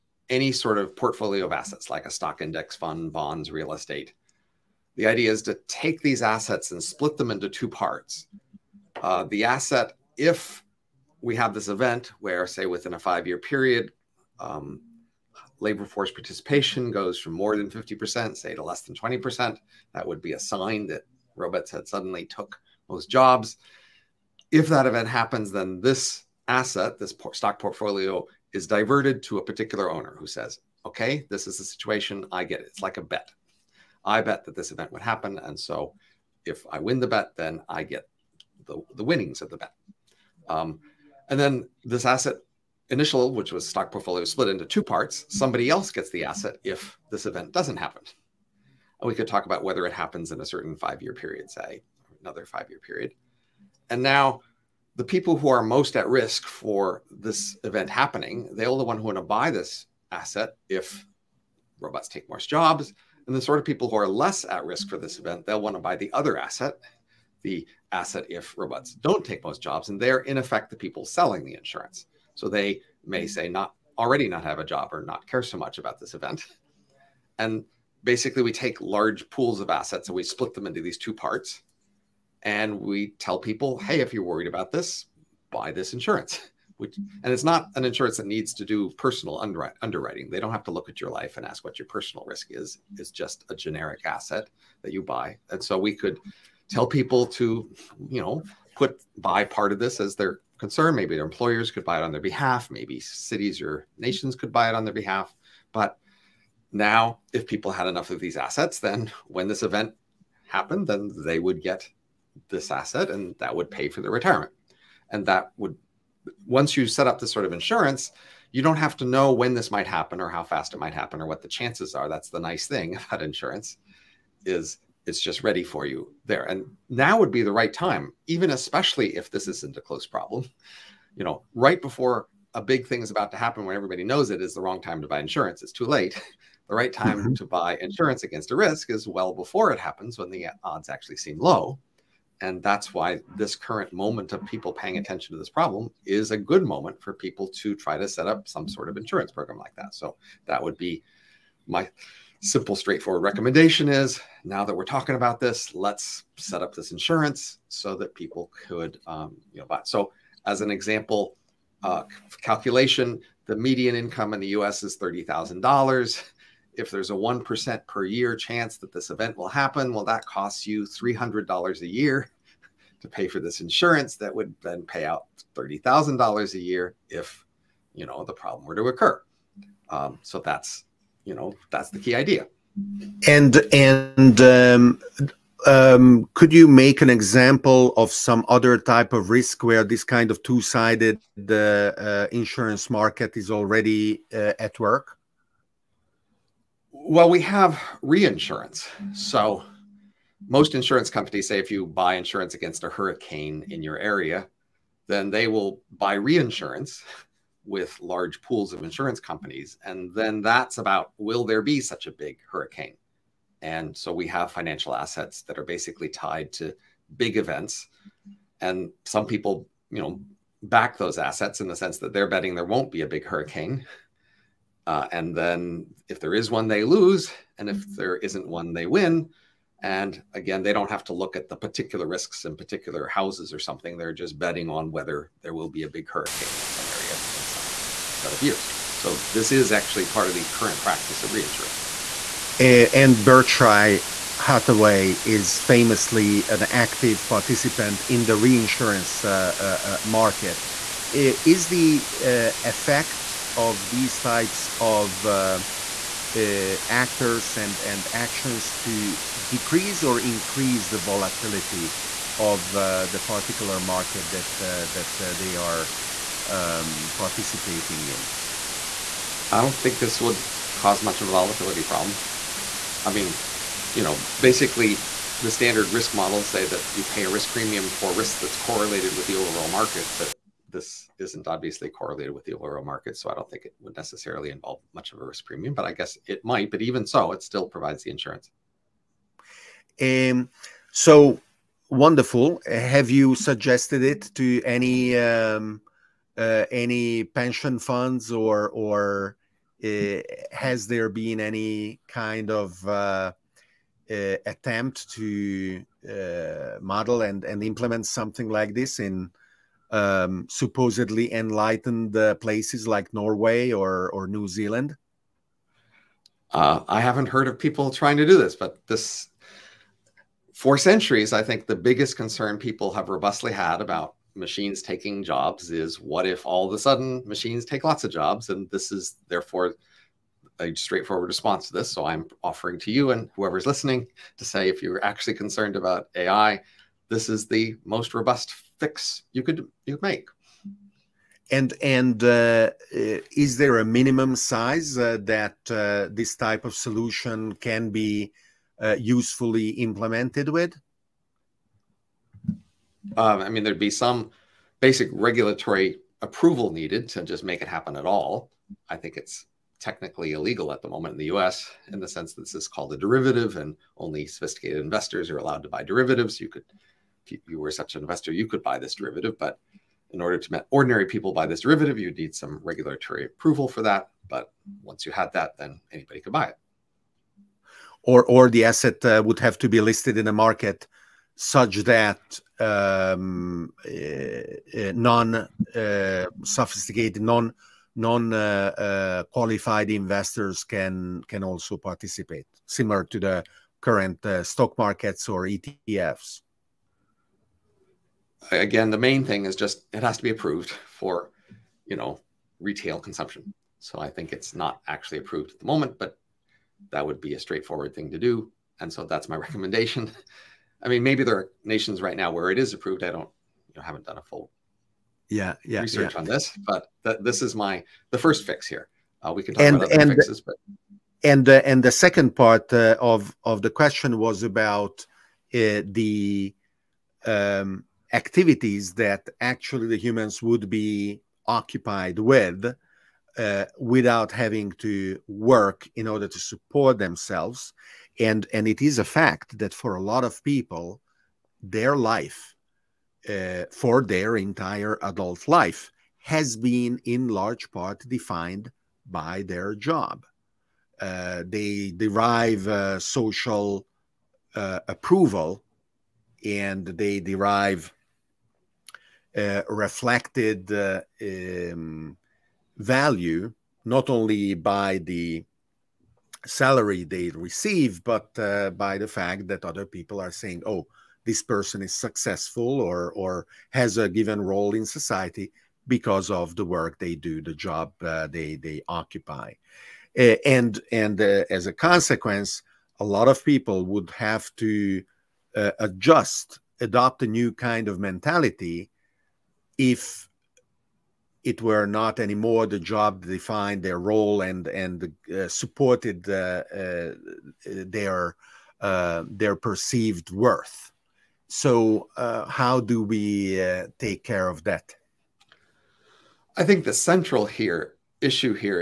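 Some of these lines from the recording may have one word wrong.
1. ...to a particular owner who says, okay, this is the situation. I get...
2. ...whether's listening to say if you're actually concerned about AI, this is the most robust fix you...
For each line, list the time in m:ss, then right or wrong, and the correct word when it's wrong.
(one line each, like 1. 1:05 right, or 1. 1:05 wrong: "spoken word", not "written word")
1. 0:29 right
2. 5:33 wrong: "whoever", not "whether".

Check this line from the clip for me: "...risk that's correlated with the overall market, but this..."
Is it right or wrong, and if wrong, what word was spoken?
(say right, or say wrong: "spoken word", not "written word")
right.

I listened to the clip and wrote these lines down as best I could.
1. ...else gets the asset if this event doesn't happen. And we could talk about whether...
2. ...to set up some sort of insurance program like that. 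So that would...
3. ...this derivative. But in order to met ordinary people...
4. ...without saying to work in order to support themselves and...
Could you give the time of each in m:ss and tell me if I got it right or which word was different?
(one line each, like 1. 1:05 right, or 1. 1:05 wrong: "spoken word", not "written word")
1. 0:45 right
2. 2:28 right
3. 6:08 right
4. 7:13 wrong: "having", not "saying".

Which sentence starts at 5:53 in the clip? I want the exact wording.
Um, I mean, there'd be some basic regulatory approval needed to just make it happen at all.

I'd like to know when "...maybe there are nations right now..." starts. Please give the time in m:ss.
6:51.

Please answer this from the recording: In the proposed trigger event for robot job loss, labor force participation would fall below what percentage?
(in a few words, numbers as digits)
20%.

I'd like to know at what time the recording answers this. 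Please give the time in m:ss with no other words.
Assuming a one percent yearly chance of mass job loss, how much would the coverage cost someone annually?
2:50.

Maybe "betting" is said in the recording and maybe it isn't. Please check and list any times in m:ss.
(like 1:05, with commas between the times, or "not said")
3:42, 3:54.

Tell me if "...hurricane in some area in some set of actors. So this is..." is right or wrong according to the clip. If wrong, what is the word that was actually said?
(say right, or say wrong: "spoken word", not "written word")
wrong: "years", not "actors".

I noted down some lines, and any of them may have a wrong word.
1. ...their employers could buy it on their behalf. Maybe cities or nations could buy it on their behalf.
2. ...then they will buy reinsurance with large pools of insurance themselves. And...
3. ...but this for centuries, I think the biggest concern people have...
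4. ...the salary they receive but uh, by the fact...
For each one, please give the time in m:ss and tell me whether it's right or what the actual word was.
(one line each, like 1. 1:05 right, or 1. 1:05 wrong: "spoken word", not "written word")
1. 1:41 right
2. 3:25 wrong: "companies", not "themselves"
3. 5:18 right
4. 7:44 right.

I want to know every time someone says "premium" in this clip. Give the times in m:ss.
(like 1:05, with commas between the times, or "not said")
4:37, 4:45.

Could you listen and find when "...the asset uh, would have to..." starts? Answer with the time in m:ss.
6:18.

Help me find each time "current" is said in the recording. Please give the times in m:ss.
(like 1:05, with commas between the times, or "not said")
2:23, 4:00, 6:33.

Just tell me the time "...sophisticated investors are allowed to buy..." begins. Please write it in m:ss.
6:04.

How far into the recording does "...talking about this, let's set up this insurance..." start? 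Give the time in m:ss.
2:34.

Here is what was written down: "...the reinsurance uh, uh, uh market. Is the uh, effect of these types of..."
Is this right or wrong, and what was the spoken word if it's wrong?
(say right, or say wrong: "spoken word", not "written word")
right.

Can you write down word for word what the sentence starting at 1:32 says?
It's just a generic asset that you buy.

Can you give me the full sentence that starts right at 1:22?
And we tell people, hey, if you're worried about this, buy this insurance.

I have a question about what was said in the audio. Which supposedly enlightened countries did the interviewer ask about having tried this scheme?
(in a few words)
Norway.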